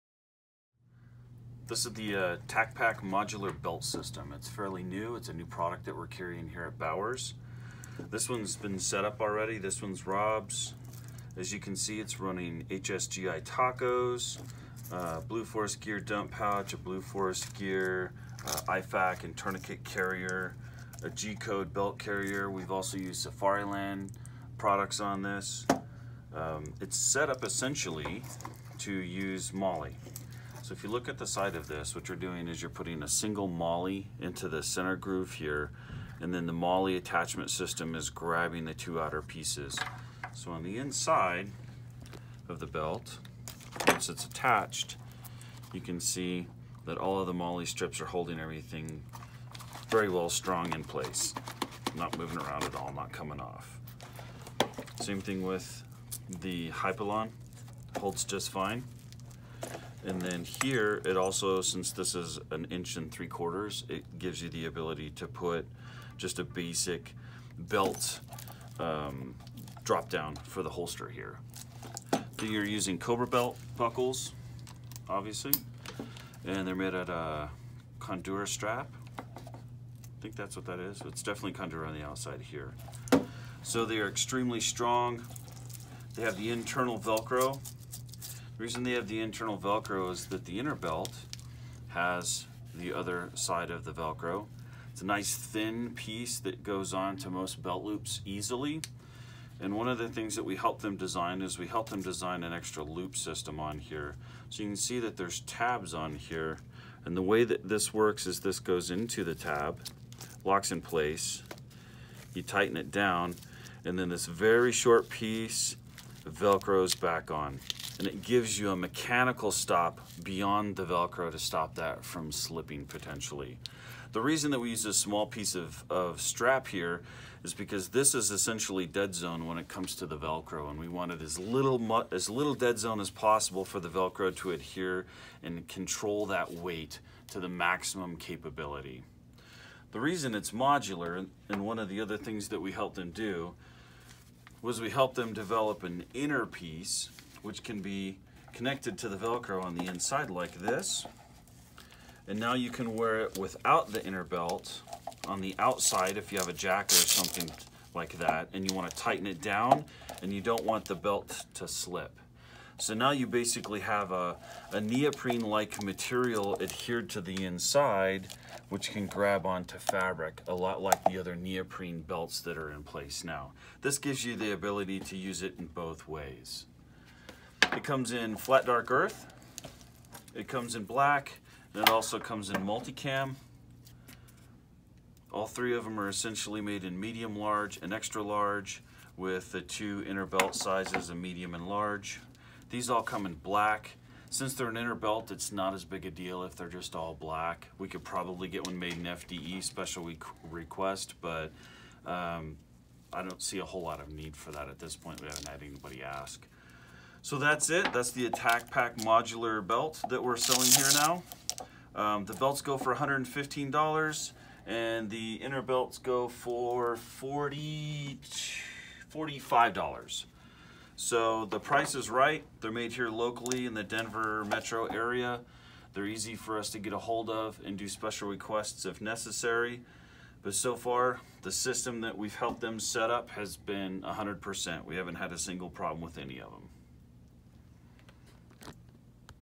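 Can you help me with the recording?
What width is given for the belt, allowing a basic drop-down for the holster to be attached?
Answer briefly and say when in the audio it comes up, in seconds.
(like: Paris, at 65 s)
1 3/4 inches, at 62 s.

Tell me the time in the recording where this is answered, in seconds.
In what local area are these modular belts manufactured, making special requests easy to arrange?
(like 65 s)
223 s.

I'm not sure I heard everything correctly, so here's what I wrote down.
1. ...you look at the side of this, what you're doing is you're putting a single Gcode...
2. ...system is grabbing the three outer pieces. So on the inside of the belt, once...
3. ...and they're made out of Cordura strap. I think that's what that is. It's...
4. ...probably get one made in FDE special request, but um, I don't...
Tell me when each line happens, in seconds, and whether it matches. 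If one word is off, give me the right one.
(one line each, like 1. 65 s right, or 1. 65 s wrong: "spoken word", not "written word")
1. 30 s wrong: "MOLLE", not "Gcode"
2. 37 s wrong: "two", not "three"
3. 76 s right
4. 198 s right.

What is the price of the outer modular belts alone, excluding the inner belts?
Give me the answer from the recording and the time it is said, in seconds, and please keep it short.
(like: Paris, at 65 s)
$115, at 212 s.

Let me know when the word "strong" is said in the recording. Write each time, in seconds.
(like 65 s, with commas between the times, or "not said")
50 s, 84 s.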